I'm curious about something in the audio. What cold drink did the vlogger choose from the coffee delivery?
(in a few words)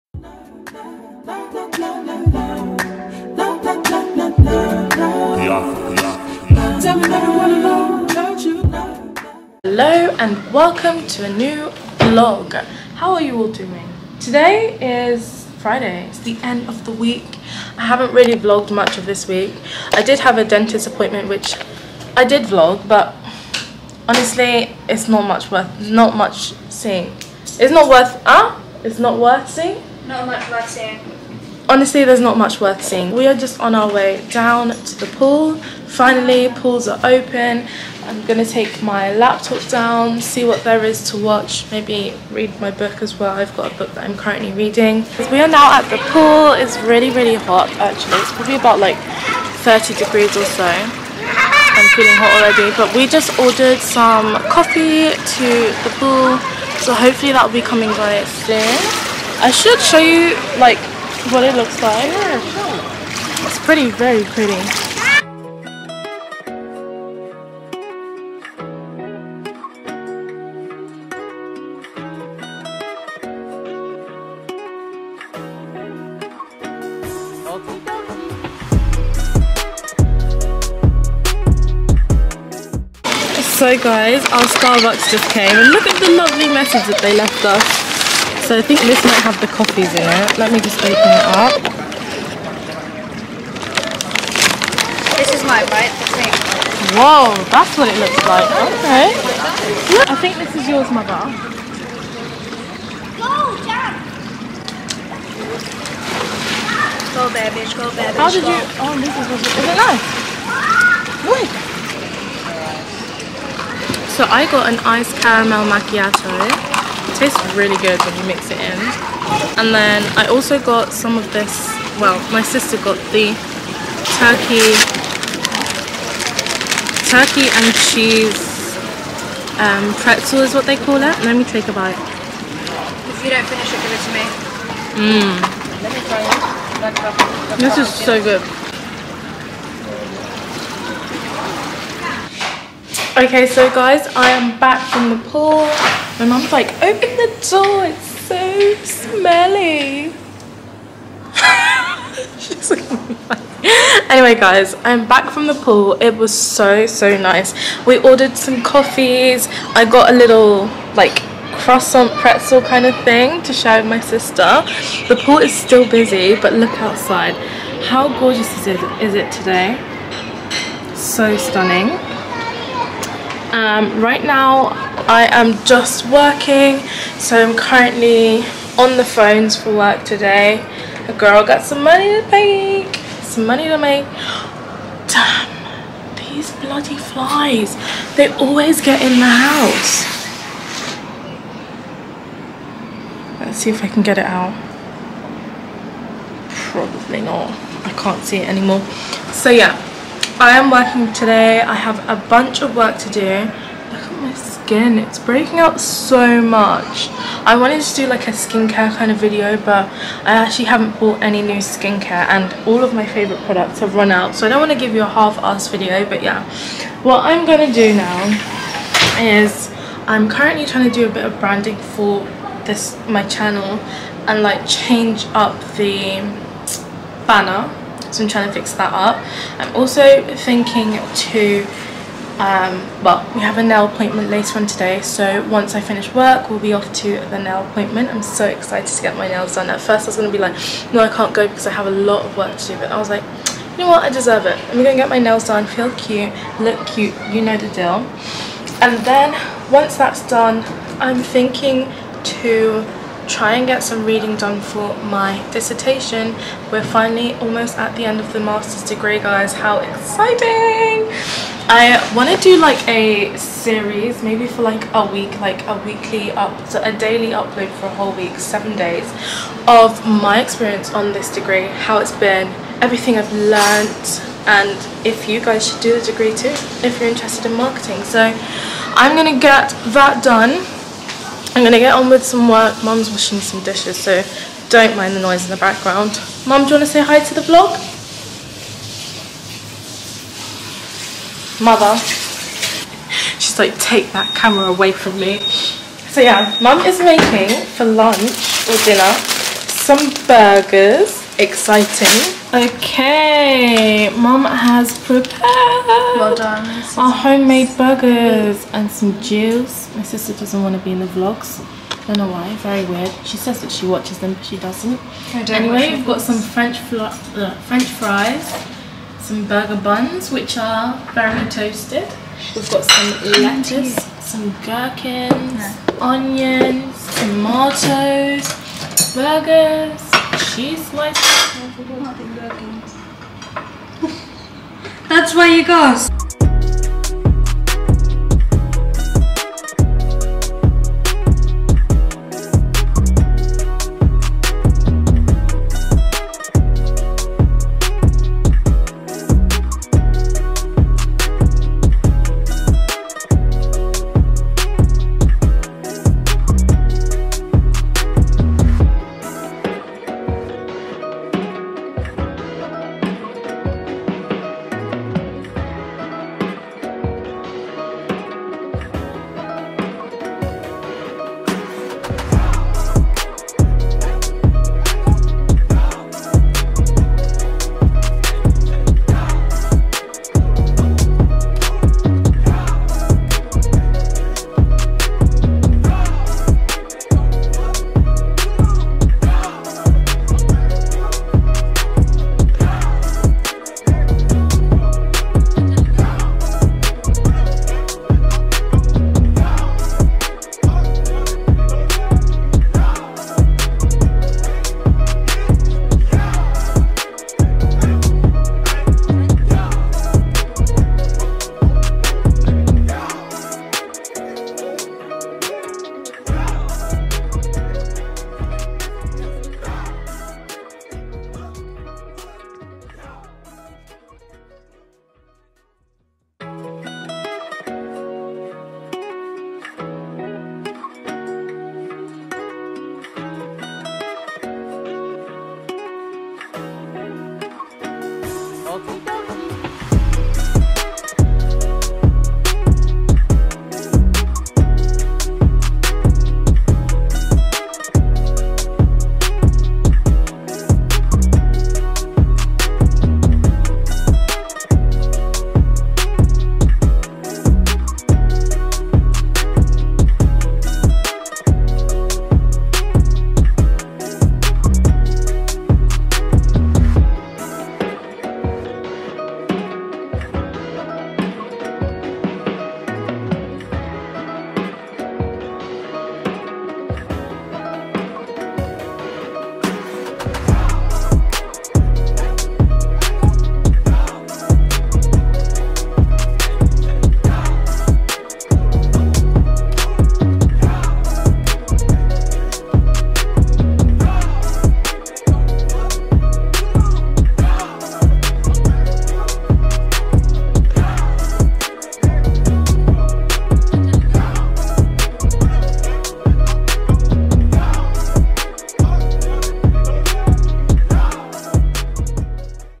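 iced caramel macchiato.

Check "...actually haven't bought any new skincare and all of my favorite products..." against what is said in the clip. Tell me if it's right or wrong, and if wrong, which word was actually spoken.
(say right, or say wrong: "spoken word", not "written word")
right.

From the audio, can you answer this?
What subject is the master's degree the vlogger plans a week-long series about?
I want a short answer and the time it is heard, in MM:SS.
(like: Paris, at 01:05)
marketing, at 04:37.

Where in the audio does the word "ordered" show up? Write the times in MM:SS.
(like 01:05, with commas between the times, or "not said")
00:53, 02:37.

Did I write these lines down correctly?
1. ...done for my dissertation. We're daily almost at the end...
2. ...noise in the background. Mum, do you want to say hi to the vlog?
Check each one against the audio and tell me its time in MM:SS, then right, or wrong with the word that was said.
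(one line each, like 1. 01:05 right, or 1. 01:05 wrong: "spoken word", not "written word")
1. 04:14 wrong: "finally", not "daily"
2. 04:45 right.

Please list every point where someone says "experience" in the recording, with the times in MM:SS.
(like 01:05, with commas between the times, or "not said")
04:30.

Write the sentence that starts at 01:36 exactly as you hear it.
Whoa, that's what it looks like.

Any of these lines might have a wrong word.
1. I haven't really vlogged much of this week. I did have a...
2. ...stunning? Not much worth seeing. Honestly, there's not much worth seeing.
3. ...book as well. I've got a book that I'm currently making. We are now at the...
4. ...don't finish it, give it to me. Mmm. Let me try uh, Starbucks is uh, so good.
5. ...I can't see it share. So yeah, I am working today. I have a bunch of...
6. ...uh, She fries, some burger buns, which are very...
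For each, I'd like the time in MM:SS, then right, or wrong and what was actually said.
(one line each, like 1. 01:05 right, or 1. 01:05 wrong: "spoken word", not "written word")
1. 00:17 right
2. 00:29 wrong: "seeing", not "stunning"
3. 00:42 wrong: "reading", not "making"
4. 02:13 wrong: "This", not "Starbucks"
5. 03:17 wrong: "anymore", not "share"
6. 05:16 wrong: "French", not "She".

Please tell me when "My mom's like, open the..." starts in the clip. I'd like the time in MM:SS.
02:26.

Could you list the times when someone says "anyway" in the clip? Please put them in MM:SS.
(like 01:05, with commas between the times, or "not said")
02:34, 05:15.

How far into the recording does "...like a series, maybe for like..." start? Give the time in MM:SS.
04:22.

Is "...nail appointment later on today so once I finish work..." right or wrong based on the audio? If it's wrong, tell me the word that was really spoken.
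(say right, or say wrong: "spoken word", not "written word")
right.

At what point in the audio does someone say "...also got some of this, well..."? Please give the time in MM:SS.
02:00.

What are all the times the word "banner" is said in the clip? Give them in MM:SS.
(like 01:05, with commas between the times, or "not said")
03:47.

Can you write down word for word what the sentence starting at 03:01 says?
A girl got some money to make, some money to make.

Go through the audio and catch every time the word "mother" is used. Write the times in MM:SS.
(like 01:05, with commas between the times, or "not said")
01:40, 04:51.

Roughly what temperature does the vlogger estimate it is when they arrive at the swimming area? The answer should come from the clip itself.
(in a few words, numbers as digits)
30 degrees.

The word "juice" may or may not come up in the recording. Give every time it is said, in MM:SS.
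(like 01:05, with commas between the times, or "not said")
05:09.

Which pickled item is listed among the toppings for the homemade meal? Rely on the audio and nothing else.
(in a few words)
gherkins.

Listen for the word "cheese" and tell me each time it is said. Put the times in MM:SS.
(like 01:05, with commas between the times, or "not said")
02:07, 05:30.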